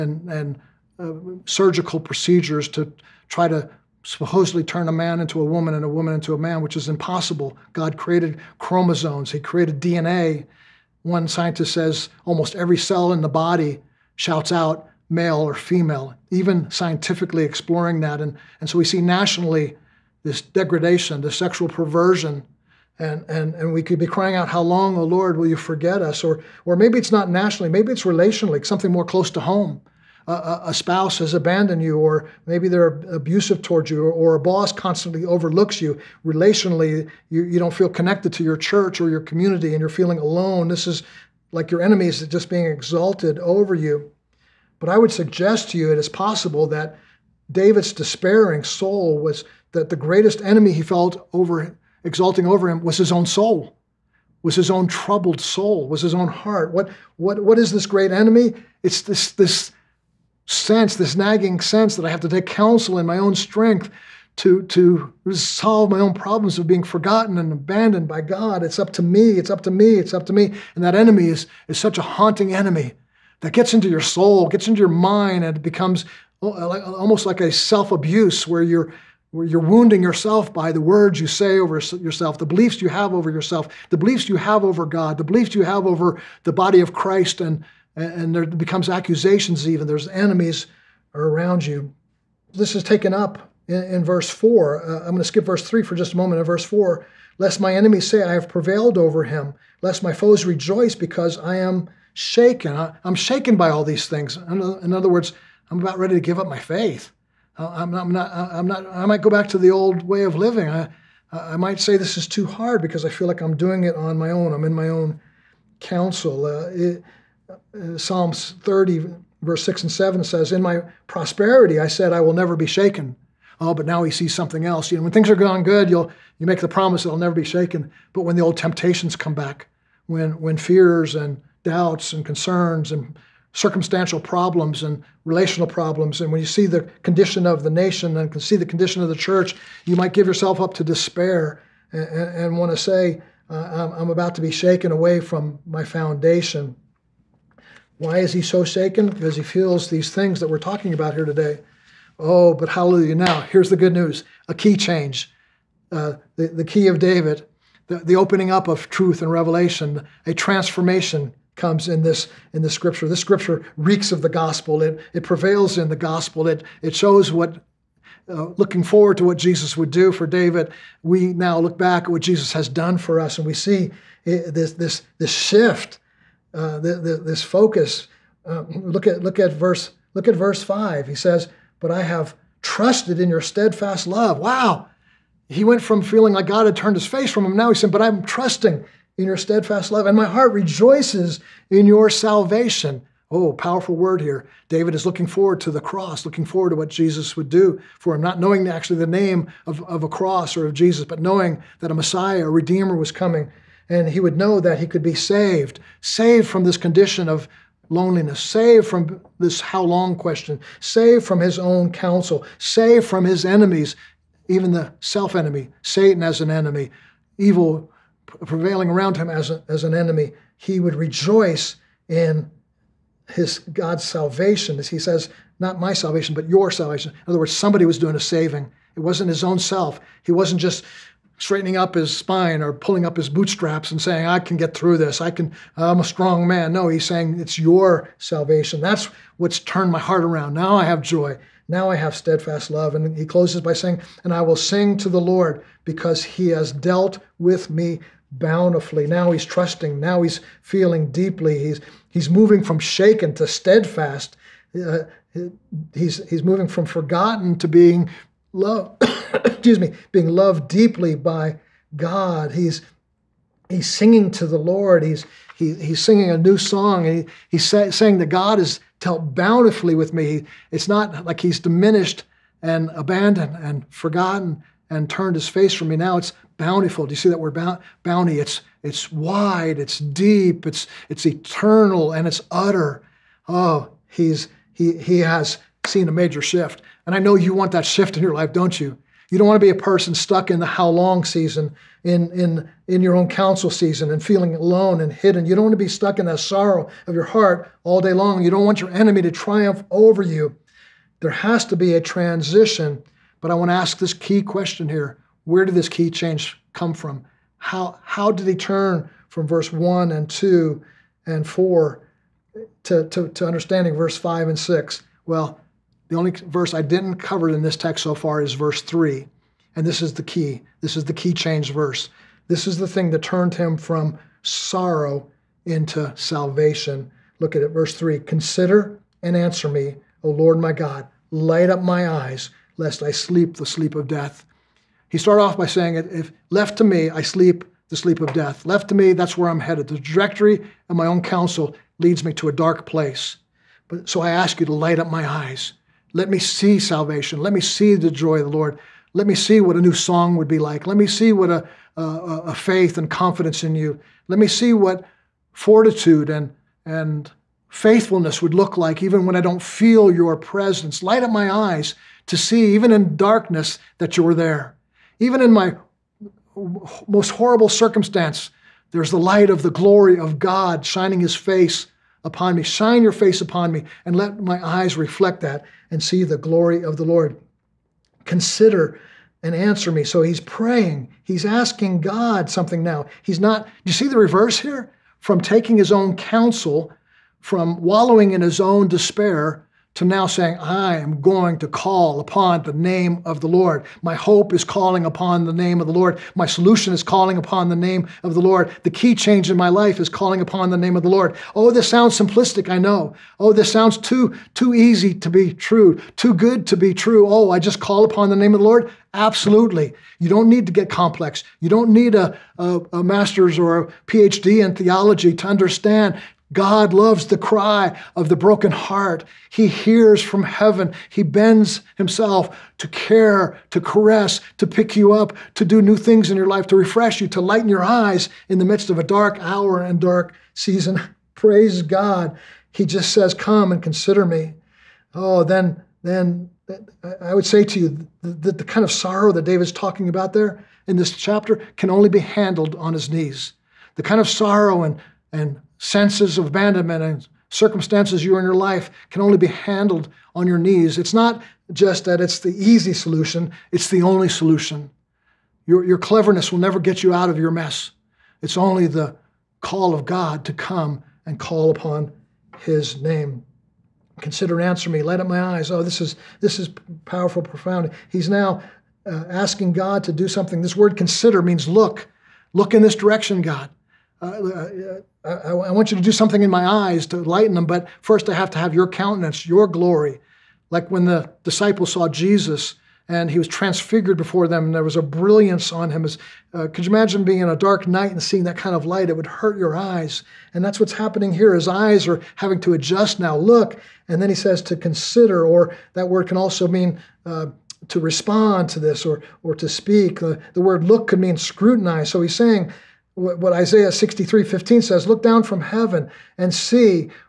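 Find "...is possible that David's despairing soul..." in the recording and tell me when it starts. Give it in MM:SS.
00:45.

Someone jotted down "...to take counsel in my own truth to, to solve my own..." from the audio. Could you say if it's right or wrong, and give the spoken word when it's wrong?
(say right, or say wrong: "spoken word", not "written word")
wrong: "strength", not "truth".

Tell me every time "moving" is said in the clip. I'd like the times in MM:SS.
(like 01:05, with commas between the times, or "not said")
04:12, 04:16.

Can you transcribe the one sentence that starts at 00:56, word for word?
What what what is this great enemy?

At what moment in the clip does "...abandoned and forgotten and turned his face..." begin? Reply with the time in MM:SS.
04:32.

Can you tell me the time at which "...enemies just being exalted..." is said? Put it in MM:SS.
00:41.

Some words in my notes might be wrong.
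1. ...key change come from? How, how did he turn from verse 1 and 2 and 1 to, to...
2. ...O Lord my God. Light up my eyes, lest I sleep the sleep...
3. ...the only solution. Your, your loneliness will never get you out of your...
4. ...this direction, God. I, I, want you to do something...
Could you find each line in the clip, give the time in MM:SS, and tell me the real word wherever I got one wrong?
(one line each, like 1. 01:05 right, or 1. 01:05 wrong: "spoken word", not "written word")
1. 05:05 wrong: "4", not "1"
2. 05:30 right
3. 07:33 wrong: "cleverness", not "loneliness"
4. 07:52 right.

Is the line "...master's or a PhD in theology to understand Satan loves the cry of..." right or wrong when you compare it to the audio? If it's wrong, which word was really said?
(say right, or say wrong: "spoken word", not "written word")
wrong: "God", not "Satan".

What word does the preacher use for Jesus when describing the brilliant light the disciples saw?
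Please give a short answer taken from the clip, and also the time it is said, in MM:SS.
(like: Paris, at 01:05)
transfigured, at 08:03.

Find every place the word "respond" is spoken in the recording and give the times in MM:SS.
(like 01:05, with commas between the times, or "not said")
08:18.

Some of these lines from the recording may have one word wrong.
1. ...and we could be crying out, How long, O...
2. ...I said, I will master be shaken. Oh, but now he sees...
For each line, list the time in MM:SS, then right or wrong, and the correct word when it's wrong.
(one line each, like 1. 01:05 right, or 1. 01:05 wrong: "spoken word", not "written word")
1. 00:23 right
2. 02:01 wrong: "never", not "master".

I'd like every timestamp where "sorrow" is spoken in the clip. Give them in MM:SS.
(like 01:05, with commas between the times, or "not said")
04:56, 05:24, 07:18, 07:24.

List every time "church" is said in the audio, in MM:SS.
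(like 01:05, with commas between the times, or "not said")
00:38, 02:19.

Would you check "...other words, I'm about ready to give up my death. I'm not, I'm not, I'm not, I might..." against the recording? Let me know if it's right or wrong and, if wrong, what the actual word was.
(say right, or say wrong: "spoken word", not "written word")
wrong: "faith", not "death".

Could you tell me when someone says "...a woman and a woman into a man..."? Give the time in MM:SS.
00:05.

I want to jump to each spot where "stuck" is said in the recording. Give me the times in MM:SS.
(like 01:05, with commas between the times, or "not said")
04:50, 04:55.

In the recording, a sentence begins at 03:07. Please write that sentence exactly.
Now he said, "But I'm trusting in your steadfast love, and my heart rejoices in your salvation." Oh, powerful word here.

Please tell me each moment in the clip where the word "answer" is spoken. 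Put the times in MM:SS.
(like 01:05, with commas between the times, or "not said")
05:29, 06:19, 07:44.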